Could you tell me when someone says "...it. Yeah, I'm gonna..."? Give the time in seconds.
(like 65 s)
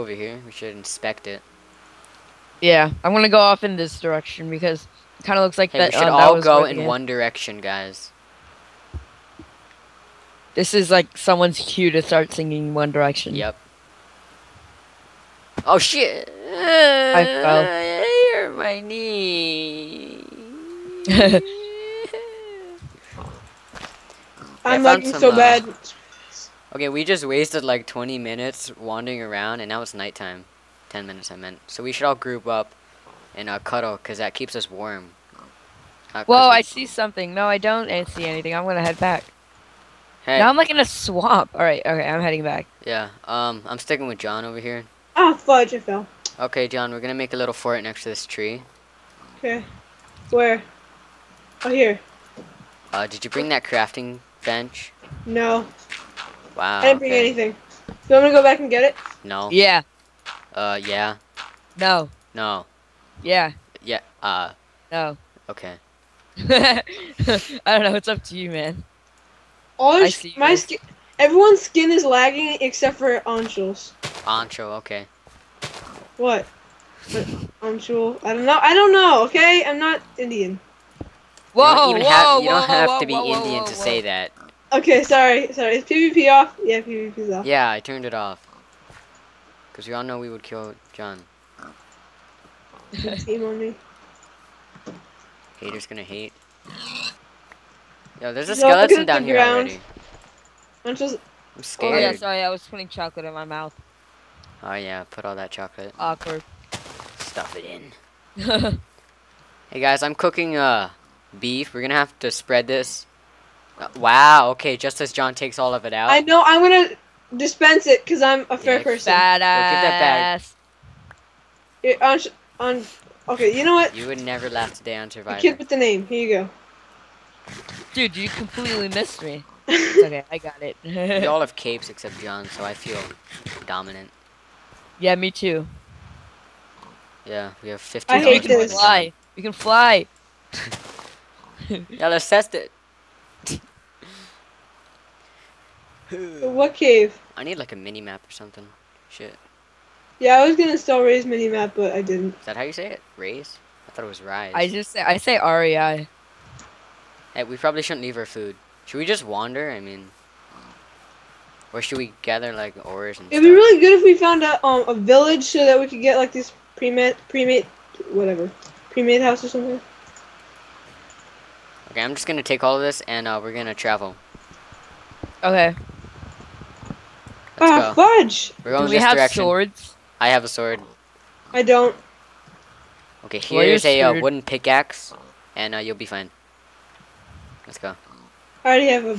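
1 s.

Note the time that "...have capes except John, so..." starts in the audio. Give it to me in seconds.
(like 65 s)
131 s.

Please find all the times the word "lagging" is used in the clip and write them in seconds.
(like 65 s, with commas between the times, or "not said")
24 s, 72 s.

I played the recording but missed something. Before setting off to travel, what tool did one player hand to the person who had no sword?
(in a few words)
wooden pickaxe.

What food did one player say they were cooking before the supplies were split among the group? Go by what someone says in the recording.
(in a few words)
beef.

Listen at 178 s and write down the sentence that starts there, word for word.
We're going Do we this have direction.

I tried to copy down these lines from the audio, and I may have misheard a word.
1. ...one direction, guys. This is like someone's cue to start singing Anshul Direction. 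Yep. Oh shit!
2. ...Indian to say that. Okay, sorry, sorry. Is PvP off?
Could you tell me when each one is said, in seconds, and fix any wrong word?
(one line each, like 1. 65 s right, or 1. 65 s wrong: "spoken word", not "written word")
1. 6 s wrong: "One", not "Anshul"
2. 83 s right.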